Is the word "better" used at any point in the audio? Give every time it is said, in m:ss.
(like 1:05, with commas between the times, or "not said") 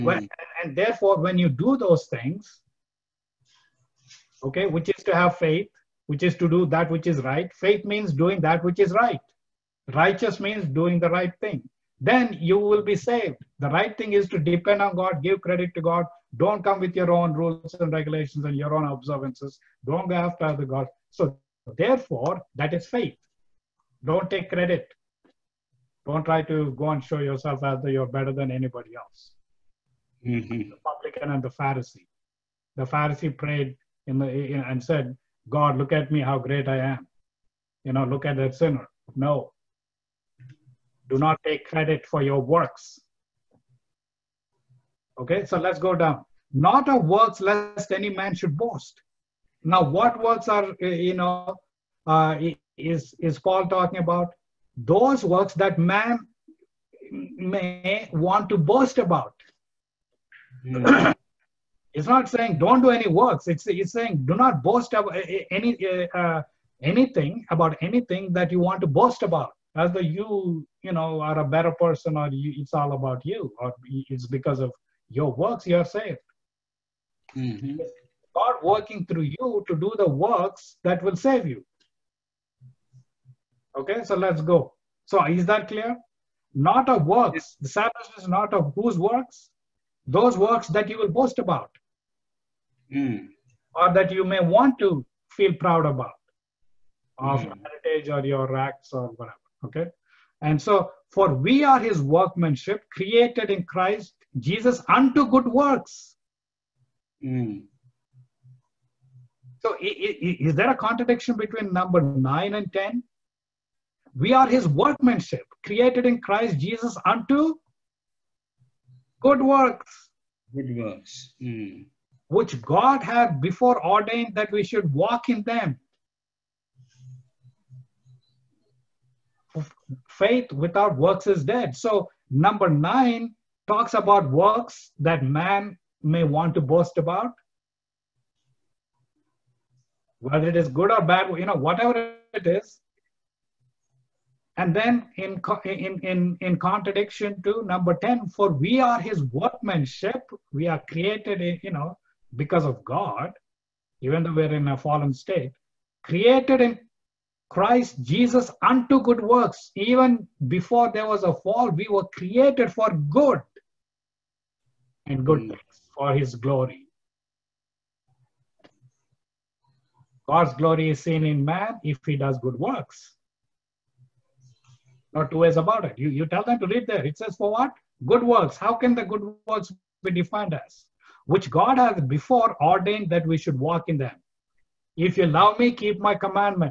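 0:28, 1:11.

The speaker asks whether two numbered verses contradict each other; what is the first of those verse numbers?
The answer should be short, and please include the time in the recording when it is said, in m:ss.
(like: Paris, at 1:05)
9, at 1:52.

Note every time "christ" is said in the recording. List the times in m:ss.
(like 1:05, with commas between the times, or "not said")
1:43, 1:56, 2:37.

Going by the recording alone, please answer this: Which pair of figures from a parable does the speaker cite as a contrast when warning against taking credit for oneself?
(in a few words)
The publican and the Pharisee.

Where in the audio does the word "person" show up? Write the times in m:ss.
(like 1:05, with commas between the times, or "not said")
1:11.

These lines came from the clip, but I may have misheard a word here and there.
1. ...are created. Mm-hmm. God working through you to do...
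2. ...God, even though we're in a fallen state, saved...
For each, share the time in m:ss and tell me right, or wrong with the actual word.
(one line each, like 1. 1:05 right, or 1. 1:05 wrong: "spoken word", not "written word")
1. 1:15 wrong: "saved", not "created"
2. 2:32 wrong: "created", not "saved".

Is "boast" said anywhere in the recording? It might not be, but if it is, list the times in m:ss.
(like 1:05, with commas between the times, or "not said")
0:48, 0:58, 1:04, 1:08, 1:31, 2:16.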